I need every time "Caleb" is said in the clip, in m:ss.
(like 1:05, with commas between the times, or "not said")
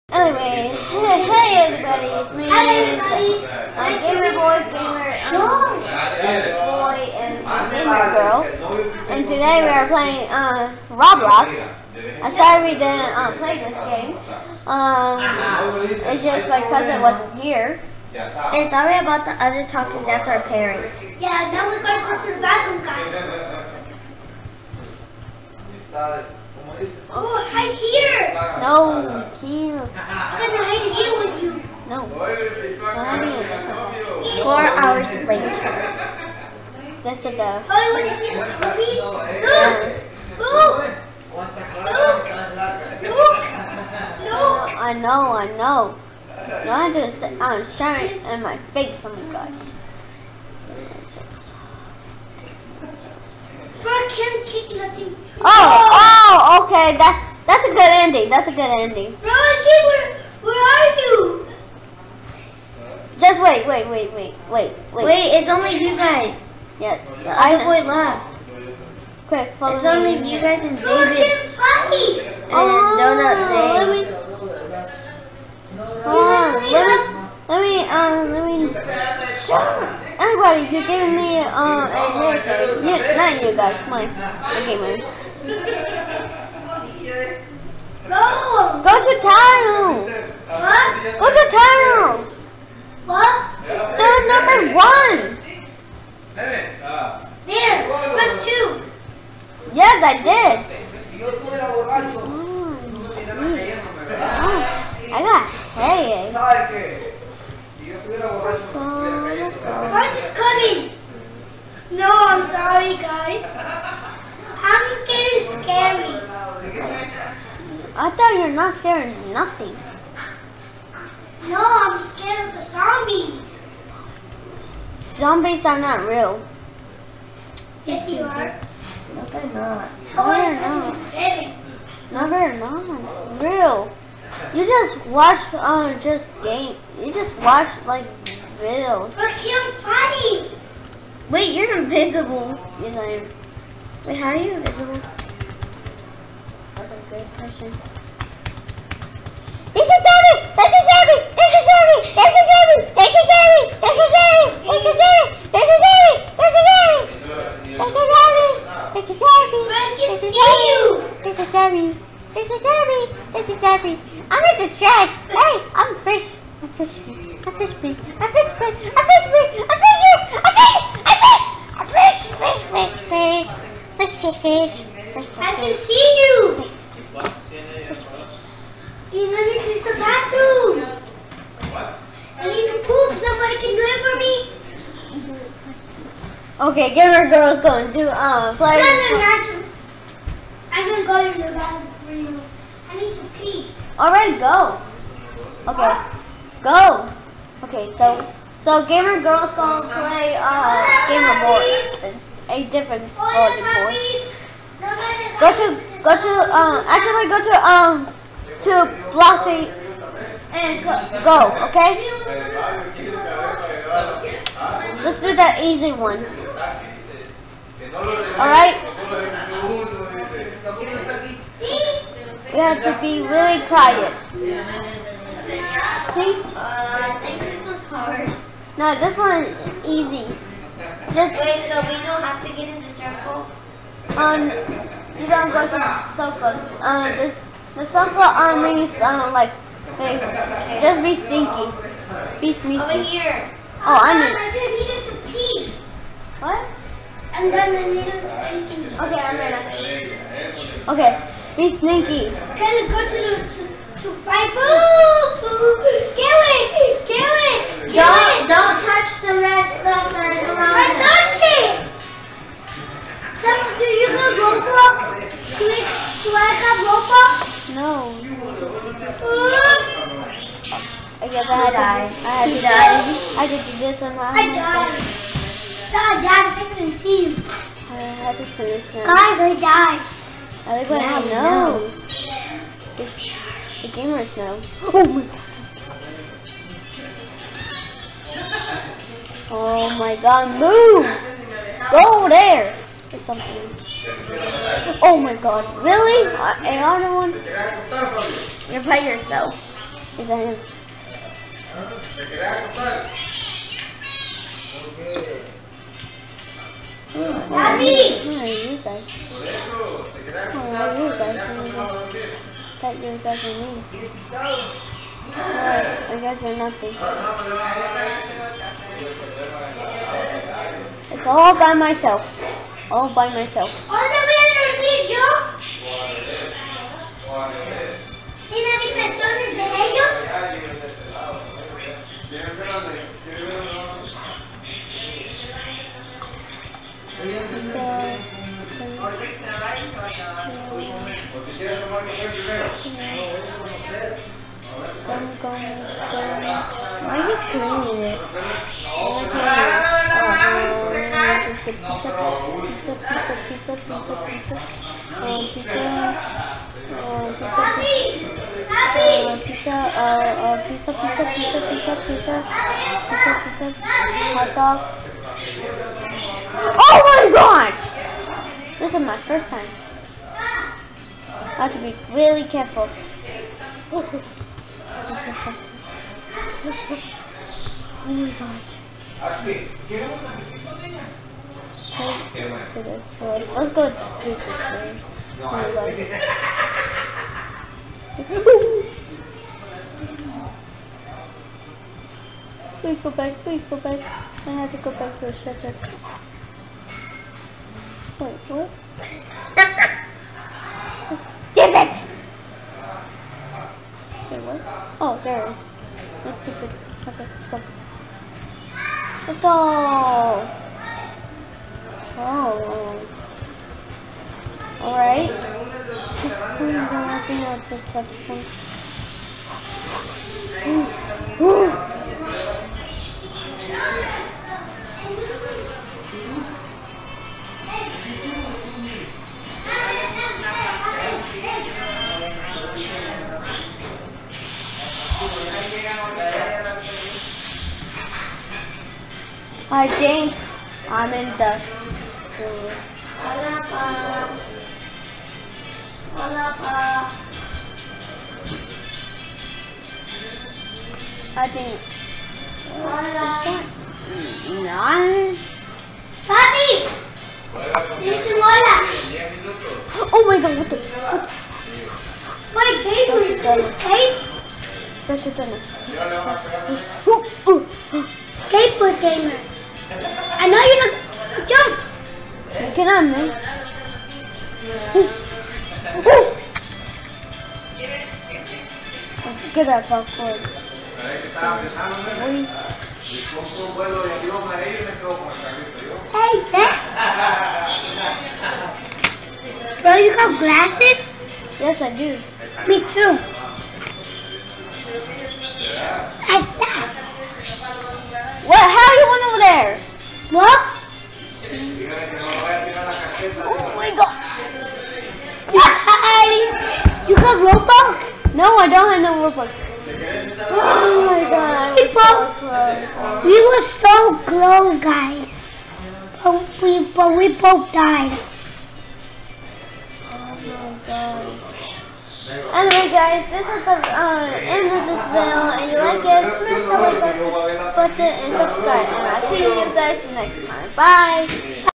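not said.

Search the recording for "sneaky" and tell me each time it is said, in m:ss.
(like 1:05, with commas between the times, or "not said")
4:02, 4:11.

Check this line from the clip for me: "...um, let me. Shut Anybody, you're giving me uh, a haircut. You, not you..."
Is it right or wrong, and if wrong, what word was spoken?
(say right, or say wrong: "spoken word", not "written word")
right.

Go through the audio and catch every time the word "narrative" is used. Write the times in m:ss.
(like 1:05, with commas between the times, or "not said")
not said.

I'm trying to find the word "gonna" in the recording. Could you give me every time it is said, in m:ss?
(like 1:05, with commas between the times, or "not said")
0:30, 3:10, 3:19, 4:07.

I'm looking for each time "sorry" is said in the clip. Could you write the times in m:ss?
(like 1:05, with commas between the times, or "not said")
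0:12, 0:18, 0:32, 1:52.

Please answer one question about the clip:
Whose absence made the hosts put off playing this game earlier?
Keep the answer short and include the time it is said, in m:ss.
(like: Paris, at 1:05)
my cousin, at 0:16.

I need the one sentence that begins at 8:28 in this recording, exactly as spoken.
No, I don't have no Robux.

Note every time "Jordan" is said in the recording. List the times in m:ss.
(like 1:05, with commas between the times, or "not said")
1:11.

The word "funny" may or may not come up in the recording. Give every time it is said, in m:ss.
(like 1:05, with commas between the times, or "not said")
1:11, 2:19.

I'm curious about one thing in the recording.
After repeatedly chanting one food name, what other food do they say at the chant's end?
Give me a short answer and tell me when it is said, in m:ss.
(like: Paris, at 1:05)
hot dog, at 6:03.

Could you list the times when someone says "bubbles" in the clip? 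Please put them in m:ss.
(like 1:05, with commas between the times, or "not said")
not said.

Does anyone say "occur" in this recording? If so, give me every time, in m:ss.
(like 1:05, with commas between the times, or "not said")
not said.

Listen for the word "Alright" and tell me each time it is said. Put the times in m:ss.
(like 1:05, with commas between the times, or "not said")
3:14, 3:38, 6:54.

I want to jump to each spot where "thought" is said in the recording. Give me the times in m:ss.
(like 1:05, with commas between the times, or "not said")
1:58.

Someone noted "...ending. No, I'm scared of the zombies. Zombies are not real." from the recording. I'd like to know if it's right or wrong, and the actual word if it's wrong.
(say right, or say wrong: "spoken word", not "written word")
wrong: "nothing", not "ending".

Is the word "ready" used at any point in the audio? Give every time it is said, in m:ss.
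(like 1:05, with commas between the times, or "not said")
4:09.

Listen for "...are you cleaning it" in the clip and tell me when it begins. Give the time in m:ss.
5:47.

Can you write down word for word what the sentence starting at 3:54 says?
Um, you don't go to uh, the circle.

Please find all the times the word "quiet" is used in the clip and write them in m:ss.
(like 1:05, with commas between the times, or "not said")
3:43.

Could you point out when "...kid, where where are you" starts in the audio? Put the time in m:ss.
0:59.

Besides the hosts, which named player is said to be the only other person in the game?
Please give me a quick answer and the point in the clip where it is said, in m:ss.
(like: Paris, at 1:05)
David, at 1:10.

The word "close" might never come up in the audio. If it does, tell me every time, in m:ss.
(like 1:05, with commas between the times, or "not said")
8:34.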